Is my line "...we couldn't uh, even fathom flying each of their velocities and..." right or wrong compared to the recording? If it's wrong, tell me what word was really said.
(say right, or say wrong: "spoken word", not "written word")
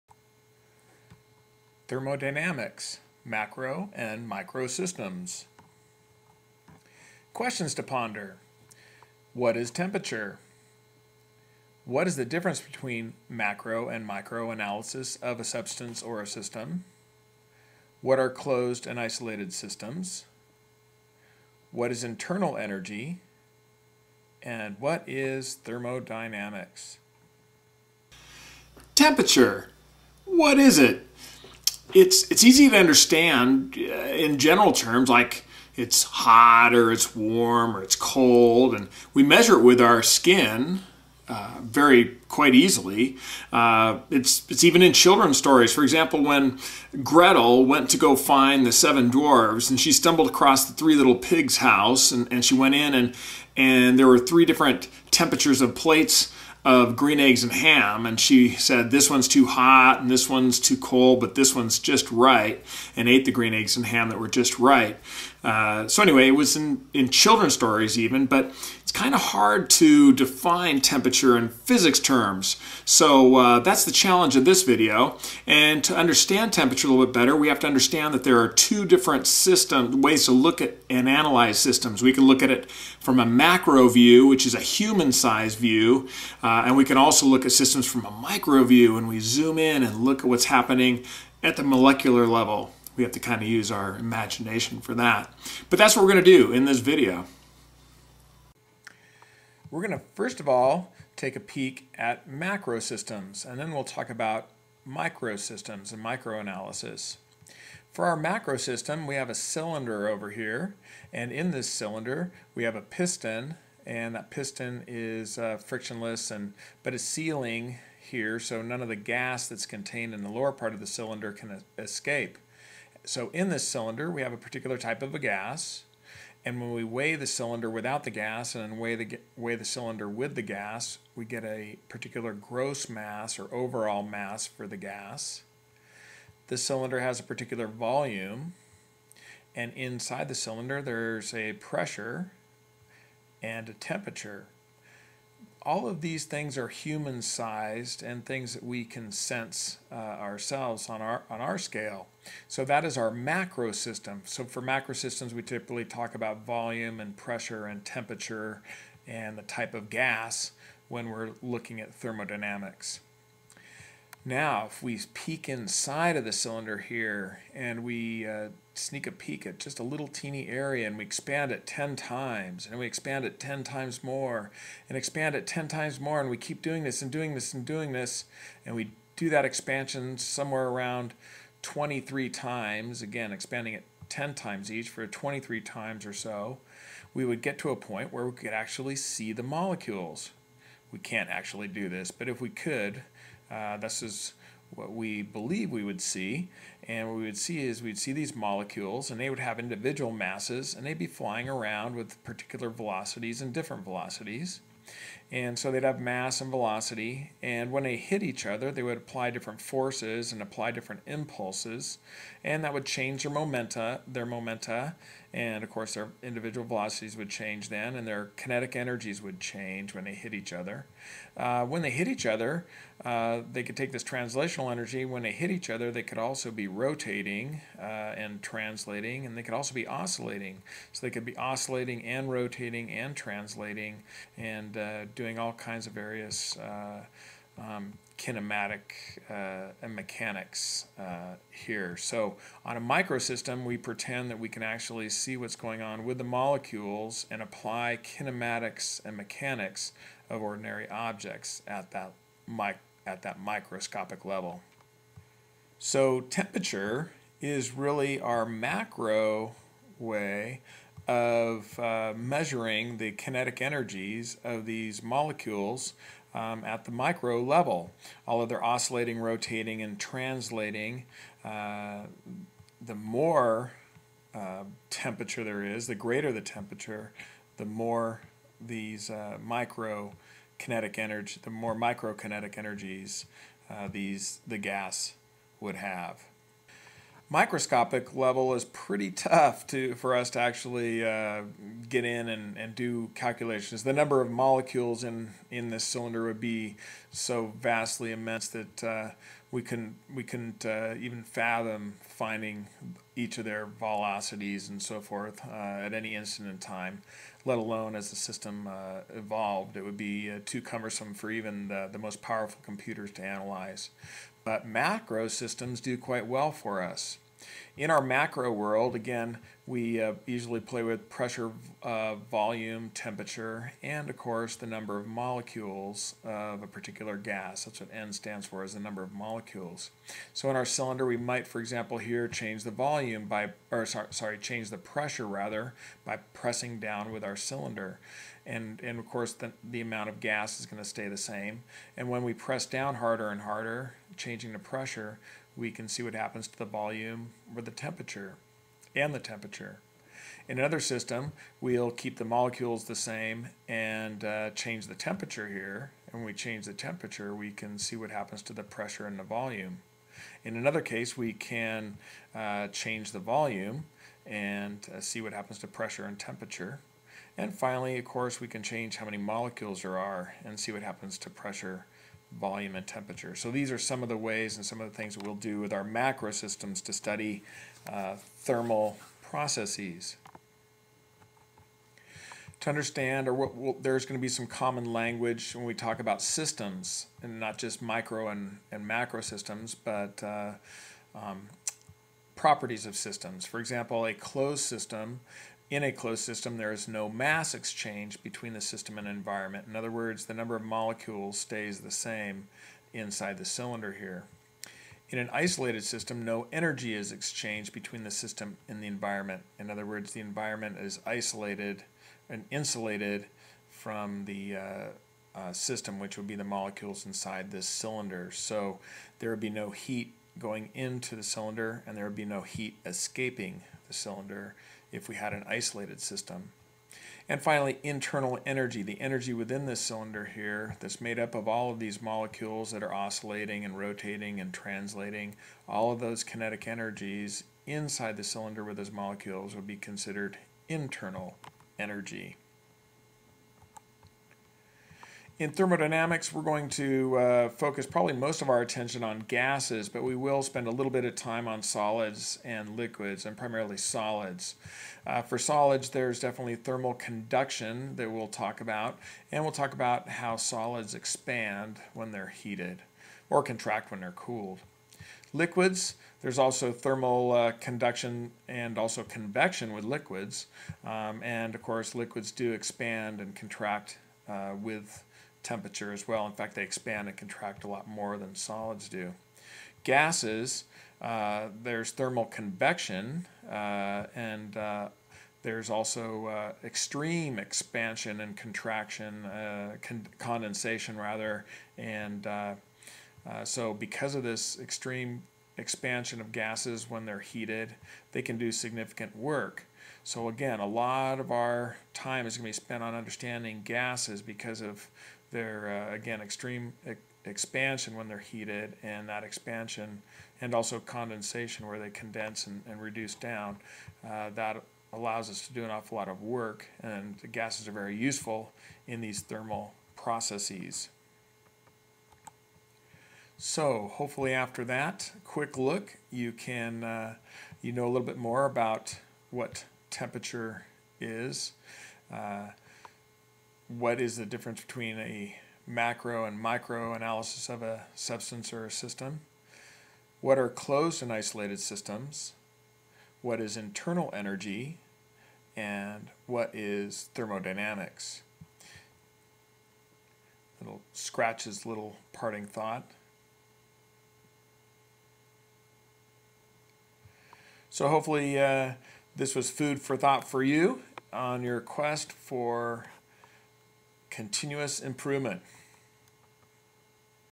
wrong: "finding", not "flying".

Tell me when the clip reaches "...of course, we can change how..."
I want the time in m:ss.
6:07.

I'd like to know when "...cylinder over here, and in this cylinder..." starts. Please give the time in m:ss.
1:49.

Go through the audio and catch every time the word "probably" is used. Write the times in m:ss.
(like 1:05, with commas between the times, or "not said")
7:27.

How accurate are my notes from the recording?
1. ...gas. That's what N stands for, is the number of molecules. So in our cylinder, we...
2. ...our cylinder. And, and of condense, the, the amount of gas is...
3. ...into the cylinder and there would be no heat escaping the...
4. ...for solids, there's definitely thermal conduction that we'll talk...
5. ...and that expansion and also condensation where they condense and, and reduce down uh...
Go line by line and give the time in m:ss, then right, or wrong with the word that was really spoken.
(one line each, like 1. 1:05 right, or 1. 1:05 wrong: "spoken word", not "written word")
1. 5:27 right
2. 5:37 wrong: "course", not "condense"
3. 7:00 right
4. 7:35 right
5. 8:28 right.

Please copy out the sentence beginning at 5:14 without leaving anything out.
But macro systems do quite well for us.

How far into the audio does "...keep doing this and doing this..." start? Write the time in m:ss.
2:56.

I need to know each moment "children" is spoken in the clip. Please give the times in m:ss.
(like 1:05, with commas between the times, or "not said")
0:44, 1:07.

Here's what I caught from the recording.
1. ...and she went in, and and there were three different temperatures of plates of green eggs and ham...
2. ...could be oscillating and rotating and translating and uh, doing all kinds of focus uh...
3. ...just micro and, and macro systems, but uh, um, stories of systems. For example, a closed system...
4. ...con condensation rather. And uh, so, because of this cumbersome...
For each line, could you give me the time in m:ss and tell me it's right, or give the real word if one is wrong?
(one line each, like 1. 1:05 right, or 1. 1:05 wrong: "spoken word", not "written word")
1. 0:52 right
2. 3:51 wrong: "various", not "focus"
3. 6:27 wrong: "properties", not "stories"
4. 8:09 wrong: "extreme", not "cumbersome".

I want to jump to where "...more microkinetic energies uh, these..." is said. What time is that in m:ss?
4:41.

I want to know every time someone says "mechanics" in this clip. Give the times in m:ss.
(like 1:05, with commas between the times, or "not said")
3:59, 4:09.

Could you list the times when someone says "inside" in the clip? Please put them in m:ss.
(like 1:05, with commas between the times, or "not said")
2:19, 2:45, 6:42, 6:57, 7:17.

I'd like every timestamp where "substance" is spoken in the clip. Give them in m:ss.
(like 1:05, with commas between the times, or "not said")
0:15, 8:57.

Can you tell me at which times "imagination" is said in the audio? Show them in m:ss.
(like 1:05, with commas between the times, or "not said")
1:33.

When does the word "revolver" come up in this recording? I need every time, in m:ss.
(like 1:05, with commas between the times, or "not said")
not said.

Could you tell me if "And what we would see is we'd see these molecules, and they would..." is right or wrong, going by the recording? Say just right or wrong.
right.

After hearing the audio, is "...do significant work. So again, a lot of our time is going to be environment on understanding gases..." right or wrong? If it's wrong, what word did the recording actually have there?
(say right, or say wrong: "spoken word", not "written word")
wrong: "spent", not "environment".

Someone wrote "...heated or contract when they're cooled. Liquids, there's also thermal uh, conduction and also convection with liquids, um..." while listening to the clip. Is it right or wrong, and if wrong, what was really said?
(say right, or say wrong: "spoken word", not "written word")
right.